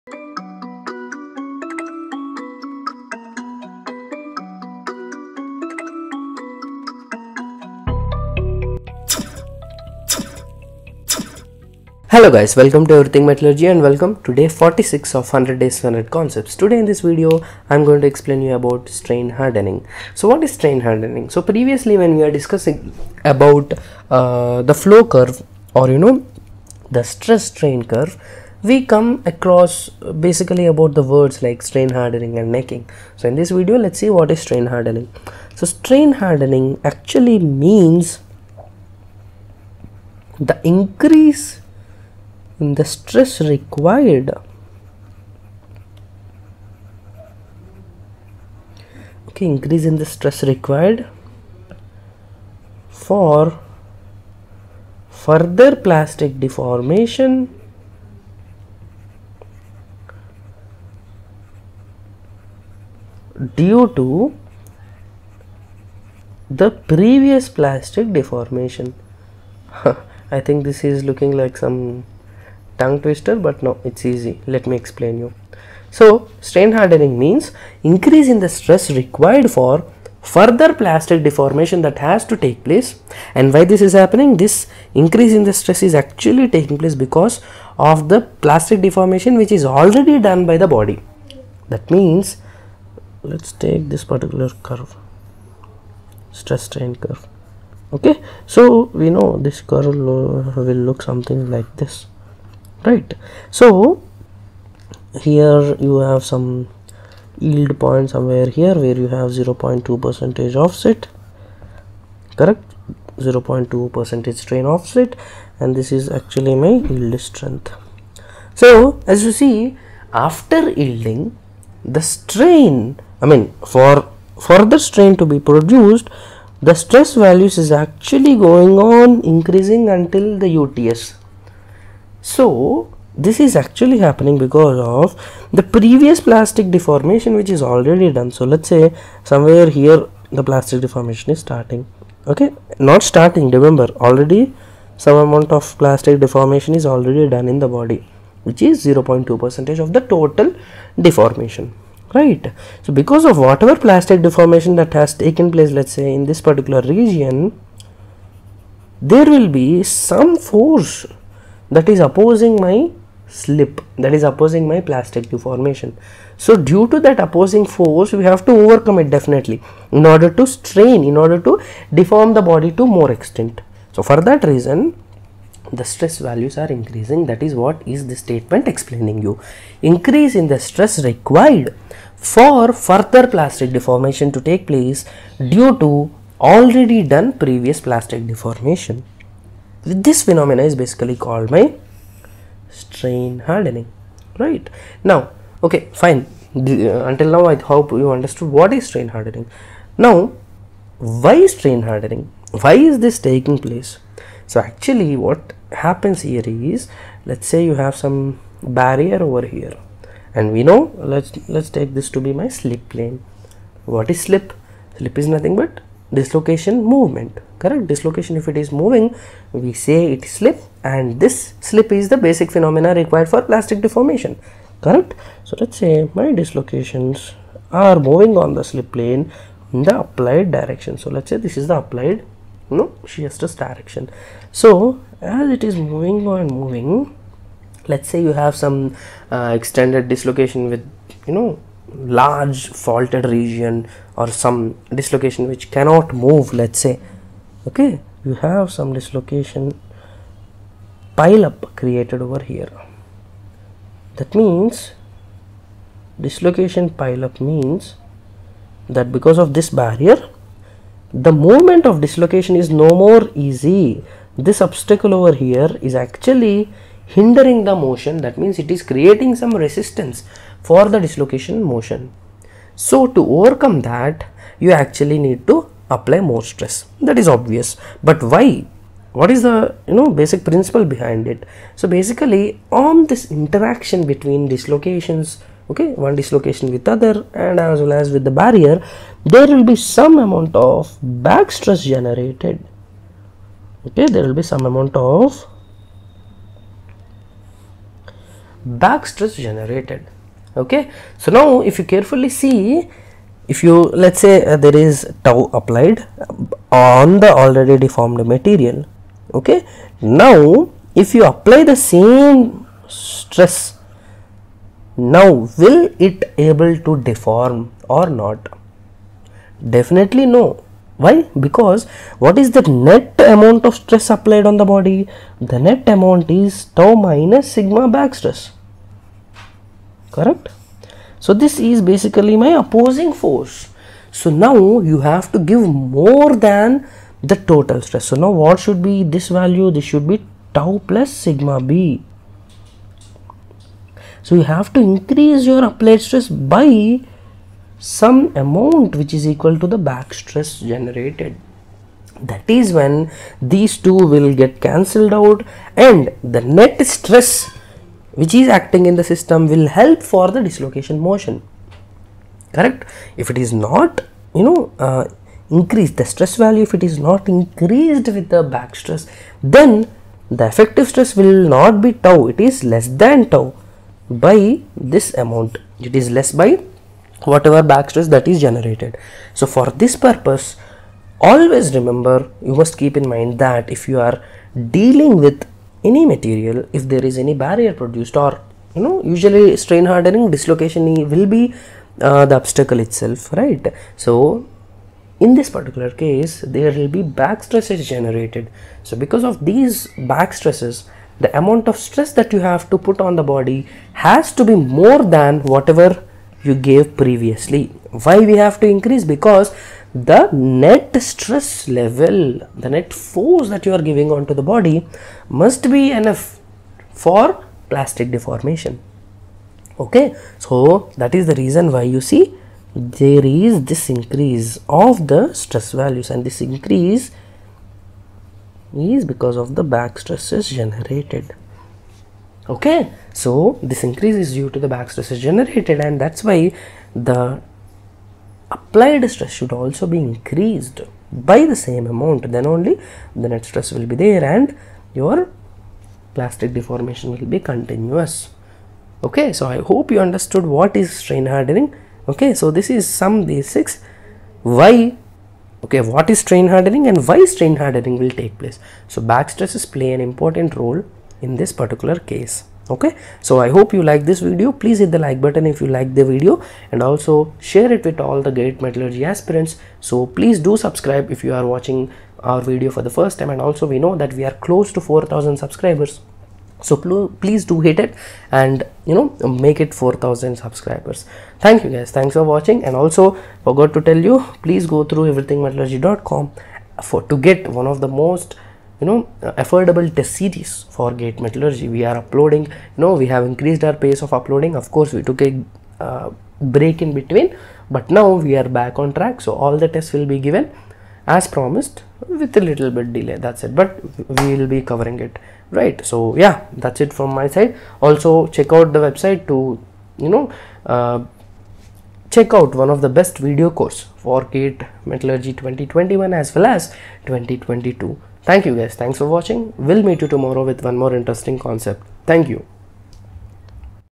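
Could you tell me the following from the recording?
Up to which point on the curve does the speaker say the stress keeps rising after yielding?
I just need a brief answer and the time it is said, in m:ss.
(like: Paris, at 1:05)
UTS, at 2:10.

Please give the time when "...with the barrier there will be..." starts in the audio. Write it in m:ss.
4:48.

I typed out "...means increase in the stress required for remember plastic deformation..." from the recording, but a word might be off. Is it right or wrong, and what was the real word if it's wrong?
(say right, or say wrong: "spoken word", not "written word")
wrong: "further", not "remember".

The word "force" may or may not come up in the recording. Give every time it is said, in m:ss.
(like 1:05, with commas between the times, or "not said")
2:40, 2:47, 5:33, 6:52.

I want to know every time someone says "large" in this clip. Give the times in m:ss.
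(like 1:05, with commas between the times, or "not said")
4:02.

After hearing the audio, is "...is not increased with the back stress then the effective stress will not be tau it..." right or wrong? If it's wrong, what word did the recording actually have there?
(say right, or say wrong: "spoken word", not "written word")
right.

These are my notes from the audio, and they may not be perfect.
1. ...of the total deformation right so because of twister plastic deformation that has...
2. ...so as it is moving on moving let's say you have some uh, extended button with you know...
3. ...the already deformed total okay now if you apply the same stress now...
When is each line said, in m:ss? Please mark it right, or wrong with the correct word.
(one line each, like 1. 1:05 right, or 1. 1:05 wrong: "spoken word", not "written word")
1. 2:29 wrong: "whatever", not "twister"
2. 3:54 wrong: "dislocation", not "button"
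3. 5:07 wrong: "material", not "total".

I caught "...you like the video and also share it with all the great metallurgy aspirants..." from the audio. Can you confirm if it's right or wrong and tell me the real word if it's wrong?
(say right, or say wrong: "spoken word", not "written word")
right.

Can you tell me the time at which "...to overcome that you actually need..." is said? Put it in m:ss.
4:33.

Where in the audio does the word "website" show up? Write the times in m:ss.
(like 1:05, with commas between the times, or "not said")
8:28.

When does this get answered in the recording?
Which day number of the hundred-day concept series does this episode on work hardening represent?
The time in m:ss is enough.
0:14.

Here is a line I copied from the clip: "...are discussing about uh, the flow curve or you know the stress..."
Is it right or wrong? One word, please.
right.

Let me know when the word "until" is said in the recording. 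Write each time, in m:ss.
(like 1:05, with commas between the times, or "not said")
2:09, 3:17.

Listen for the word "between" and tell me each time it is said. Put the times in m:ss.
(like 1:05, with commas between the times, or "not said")
4:44, 8:16.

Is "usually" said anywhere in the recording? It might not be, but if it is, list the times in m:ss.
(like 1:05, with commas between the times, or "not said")
6:29.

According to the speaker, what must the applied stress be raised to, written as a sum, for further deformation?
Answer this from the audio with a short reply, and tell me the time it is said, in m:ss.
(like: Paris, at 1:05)
tau plus sigma b, at 5:40.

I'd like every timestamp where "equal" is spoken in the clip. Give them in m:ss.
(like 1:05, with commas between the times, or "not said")
5:49.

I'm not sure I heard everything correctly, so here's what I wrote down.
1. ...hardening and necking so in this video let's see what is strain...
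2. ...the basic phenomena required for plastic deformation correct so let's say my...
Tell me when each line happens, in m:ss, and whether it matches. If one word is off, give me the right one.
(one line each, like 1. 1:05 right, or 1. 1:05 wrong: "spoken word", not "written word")
1. 0:32 right
2. 3:42 right.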